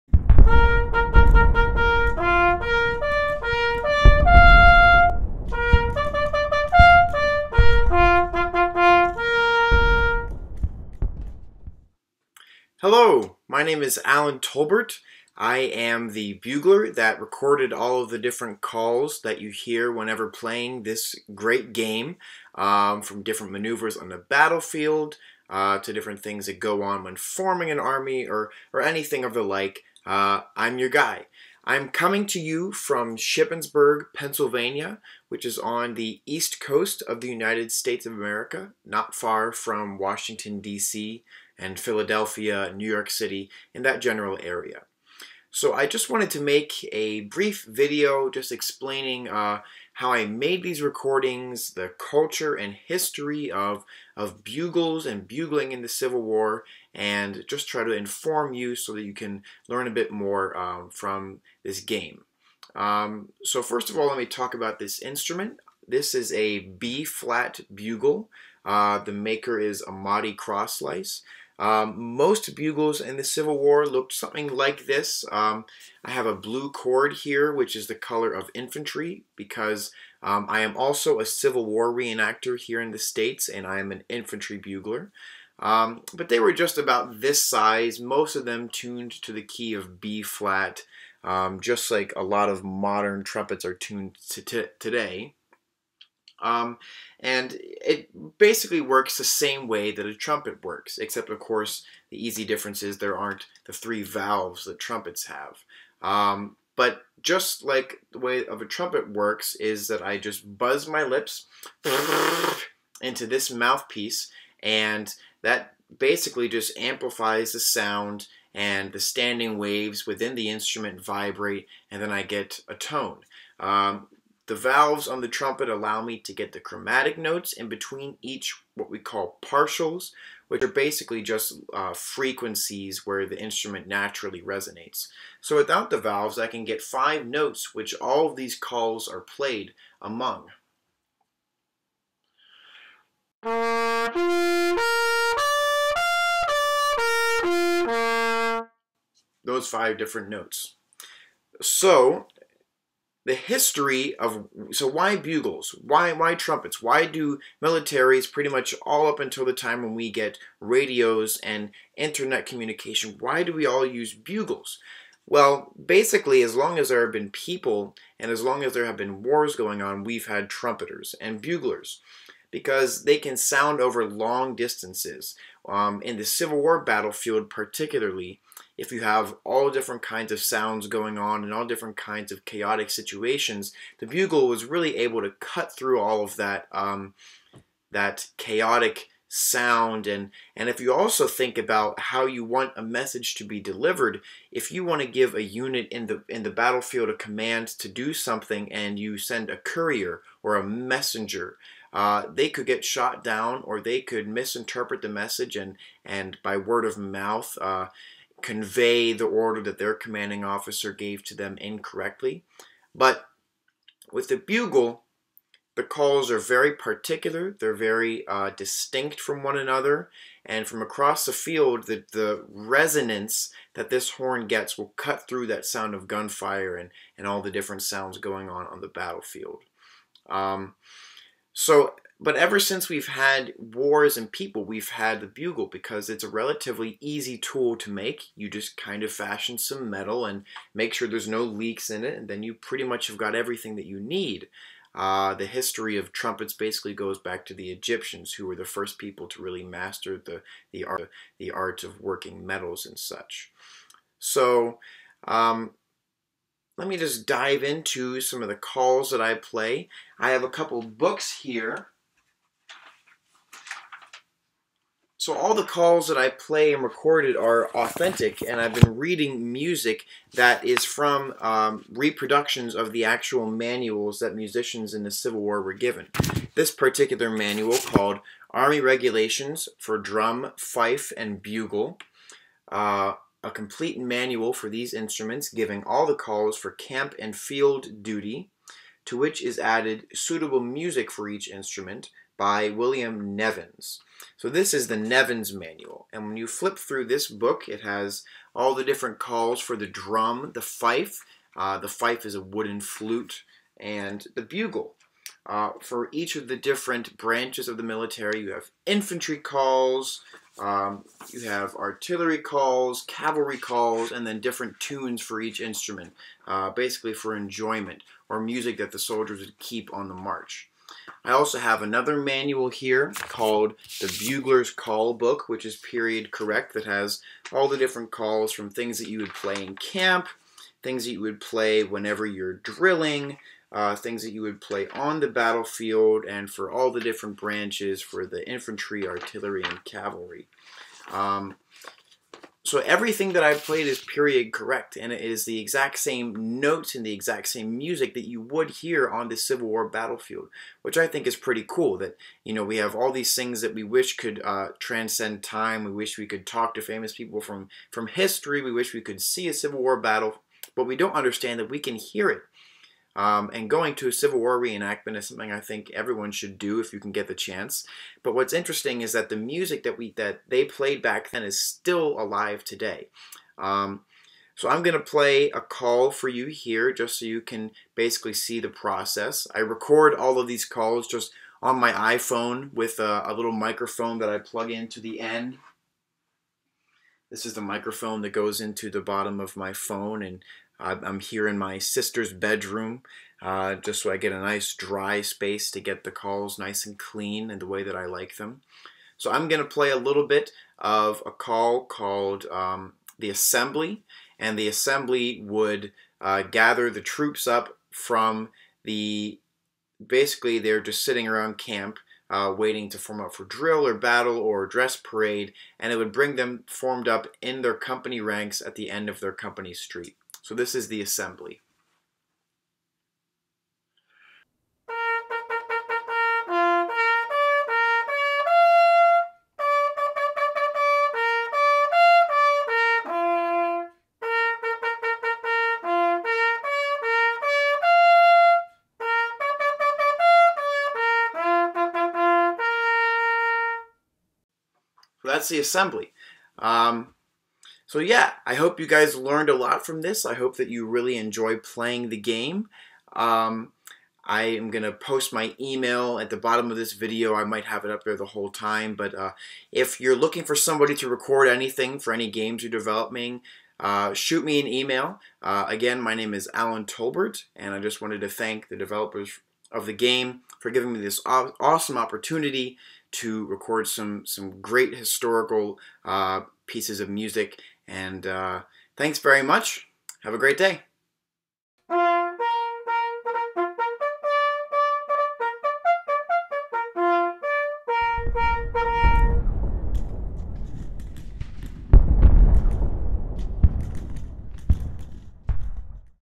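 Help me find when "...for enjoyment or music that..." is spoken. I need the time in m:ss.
5:17.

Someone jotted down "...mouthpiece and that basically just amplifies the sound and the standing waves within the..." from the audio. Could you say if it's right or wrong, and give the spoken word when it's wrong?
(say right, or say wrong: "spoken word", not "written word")
right.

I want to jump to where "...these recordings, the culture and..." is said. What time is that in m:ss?
0:50.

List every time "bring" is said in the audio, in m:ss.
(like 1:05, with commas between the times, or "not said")
6:56.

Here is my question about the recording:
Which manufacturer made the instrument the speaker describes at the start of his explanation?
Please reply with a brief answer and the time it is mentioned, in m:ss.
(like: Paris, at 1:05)
Amati Kraslice, at 1:09.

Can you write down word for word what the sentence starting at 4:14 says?
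So, um, let me just dive into some of the calls that I play.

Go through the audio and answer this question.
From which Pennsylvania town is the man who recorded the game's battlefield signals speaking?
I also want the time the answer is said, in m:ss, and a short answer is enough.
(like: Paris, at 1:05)
Shippensburg, at 0:33.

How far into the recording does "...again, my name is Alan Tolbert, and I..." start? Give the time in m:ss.
7:45.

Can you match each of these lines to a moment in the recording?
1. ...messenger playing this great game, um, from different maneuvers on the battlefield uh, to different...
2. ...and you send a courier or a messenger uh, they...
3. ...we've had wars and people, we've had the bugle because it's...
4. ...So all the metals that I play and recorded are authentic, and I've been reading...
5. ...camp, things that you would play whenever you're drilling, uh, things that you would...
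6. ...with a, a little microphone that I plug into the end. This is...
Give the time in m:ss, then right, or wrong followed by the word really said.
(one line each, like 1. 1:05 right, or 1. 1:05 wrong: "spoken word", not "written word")
1. 0:19 wrong: "whenever", not "messenger"
2. 3:18 right
3. 3:52 right
4. 4:25 wrong: "calls", not "metals"
5. 5:29 right
6. 6:22 right.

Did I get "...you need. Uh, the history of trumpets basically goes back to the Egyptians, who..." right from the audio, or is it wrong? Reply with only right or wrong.
right.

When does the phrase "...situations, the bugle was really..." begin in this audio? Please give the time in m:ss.
3:02.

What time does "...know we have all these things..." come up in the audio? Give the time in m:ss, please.
5:52.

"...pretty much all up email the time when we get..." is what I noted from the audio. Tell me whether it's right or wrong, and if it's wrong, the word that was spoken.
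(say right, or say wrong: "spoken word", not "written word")
wrong: "until", not "email".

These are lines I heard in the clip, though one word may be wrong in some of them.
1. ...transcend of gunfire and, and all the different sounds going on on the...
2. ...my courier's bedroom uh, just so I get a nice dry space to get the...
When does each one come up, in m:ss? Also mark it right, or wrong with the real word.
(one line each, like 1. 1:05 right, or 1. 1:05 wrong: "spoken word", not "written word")
1. 3:45 wrong: "sound", not "transcend"
2. 6:31 wrong: "sister", not "courier".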